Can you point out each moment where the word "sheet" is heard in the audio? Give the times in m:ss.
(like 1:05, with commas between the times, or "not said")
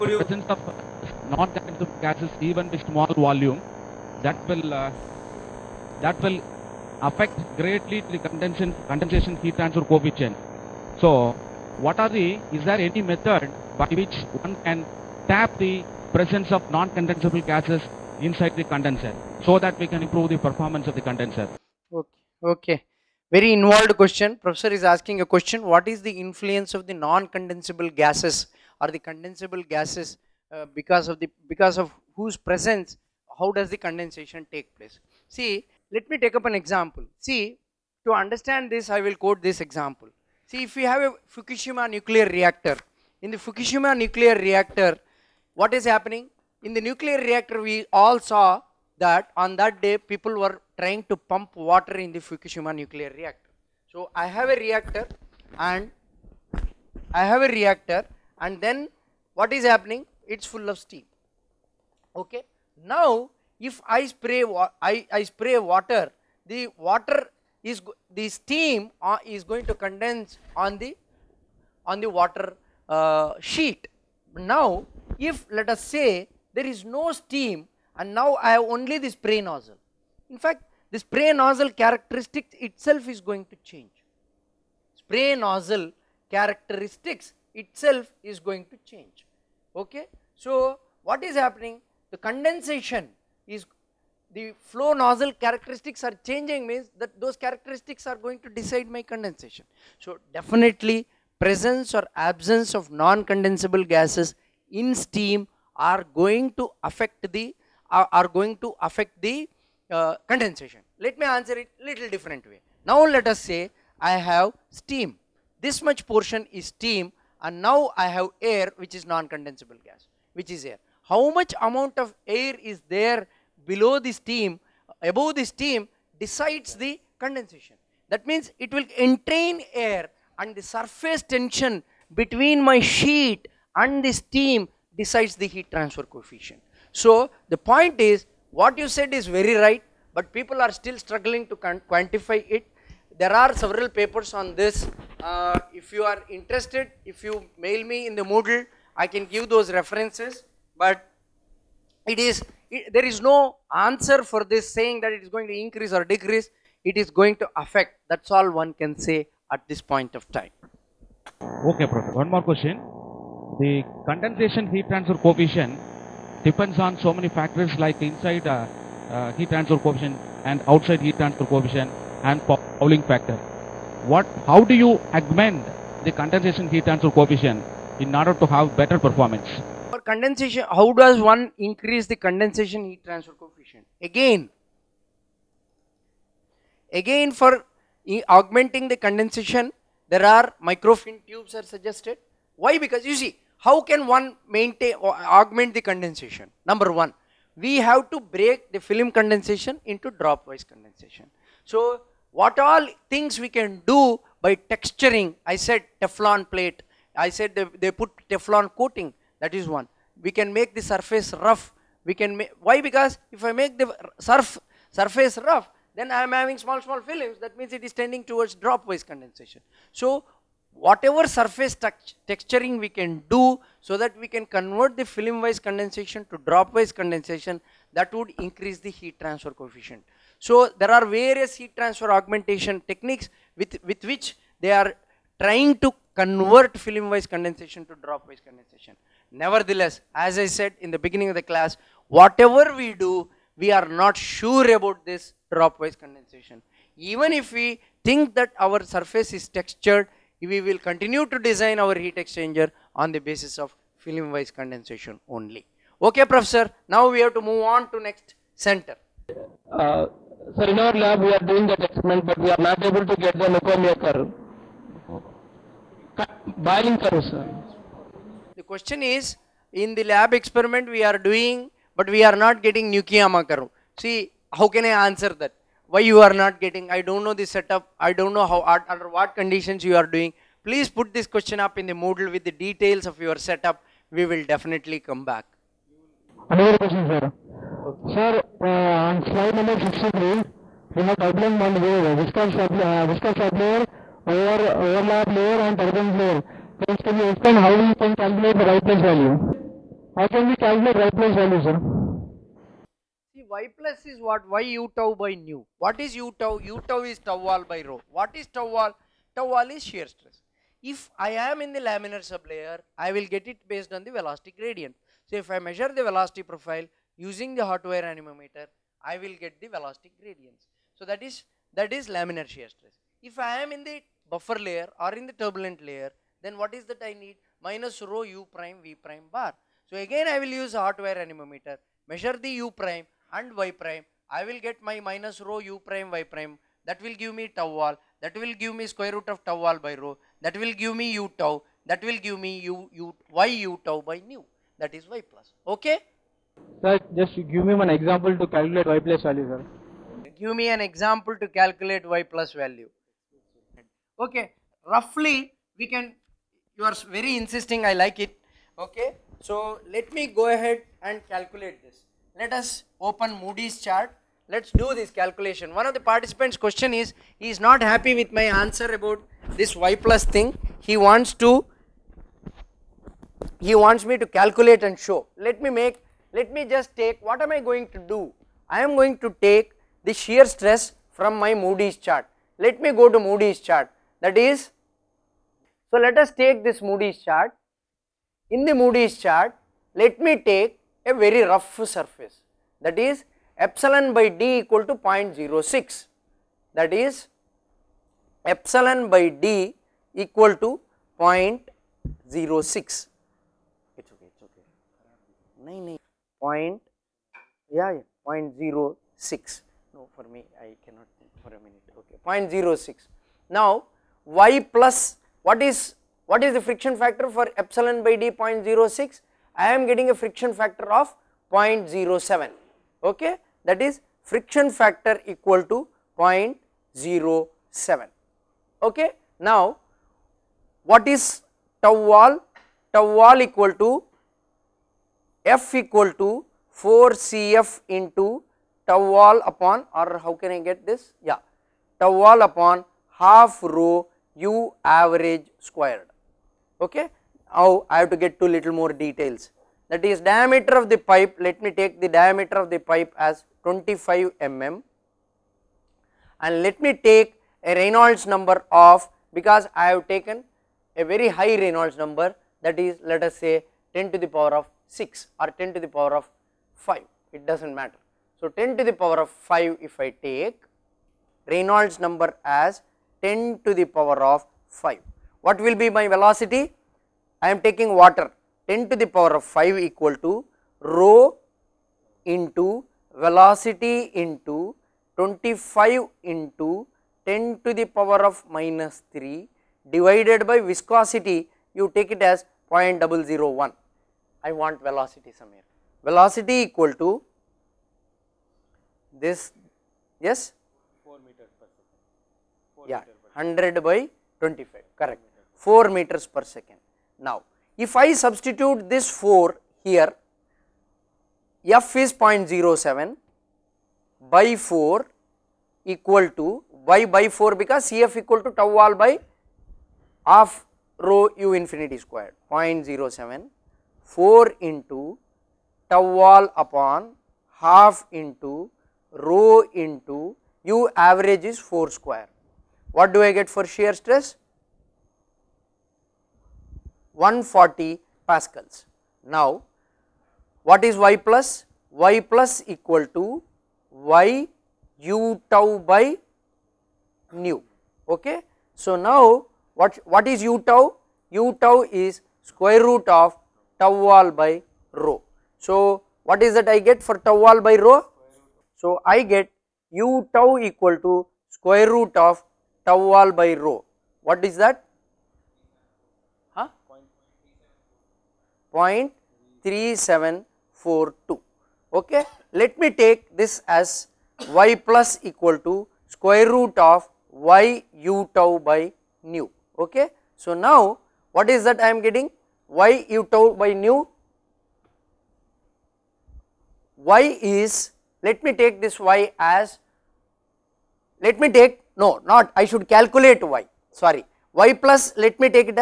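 1:13, 2:12.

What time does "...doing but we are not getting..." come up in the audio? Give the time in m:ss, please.
4:31.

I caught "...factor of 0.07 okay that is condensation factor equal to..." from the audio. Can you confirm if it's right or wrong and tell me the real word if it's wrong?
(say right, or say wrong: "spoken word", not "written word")
wrong: "friction", not "condensation".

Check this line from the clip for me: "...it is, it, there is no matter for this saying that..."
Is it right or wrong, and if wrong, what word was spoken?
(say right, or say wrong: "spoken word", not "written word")
wrong: "answer", not "matter".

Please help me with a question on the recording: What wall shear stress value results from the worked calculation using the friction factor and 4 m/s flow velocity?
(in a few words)
140 pascals.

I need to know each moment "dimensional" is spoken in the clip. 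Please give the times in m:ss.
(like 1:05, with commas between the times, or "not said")
not said.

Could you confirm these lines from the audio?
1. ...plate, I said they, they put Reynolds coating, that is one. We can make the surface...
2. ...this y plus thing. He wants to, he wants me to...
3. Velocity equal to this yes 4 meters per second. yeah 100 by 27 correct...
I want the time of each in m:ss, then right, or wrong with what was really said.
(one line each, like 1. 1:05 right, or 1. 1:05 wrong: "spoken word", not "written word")
1. 3:26 wrong: "Teflon", not "Reynolds"
2. 6:09 right
3. 8:16 wrong: "25", not "27".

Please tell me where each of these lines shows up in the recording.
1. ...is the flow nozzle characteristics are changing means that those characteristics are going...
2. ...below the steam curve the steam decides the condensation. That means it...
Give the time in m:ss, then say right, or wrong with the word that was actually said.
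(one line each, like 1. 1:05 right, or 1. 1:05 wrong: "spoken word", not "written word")
1. 1:33 right
2. 2:03 wrong: "above", not "curve".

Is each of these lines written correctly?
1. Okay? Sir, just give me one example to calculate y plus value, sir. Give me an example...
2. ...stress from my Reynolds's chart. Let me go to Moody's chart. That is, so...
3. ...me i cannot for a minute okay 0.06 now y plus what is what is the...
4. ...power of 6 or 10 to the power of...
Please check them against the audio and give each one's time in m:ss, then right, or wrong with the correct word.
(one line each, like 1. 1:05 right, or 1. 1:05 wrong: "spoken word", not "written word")
1. 5:45 right
2. 6:20 wrong: "Moody", not "Reynolds"
3. 6:50 right
4. 7:44 right.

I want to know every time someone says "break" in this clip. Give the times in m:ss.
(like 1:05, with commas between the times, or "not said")
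3:18.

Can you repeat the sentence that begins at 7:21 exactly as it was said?
Yeah, tau wall upon half rho u average squared okay.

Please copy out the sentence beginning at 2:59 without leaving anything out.
For condensation, how does one increase the condensation heat transfer coefficient?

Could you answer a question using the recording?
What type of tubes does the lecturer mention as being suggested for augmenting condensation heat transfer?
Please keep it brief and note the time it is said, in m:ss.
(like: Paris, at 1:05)
Microfin tubes, at 3:10.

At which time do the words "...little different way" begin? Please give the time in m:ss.
1:51.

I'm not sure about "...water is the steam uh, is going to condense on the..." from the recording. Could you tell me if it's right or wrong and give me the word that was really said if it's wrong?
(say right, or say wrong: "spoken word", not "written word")
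right.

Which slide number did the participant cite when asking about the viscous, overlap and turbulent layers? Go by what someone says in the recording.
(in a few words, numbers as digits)
63.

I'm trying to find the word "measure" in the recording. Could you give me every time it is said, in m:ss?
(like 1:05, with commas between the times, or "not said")
5:15, 5:32.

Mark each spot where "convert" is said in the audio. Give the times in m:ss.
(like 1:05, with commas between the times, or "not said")
3:44, 3:56.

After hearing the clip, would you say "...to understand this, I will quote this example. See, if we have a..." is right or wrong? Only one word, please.
right.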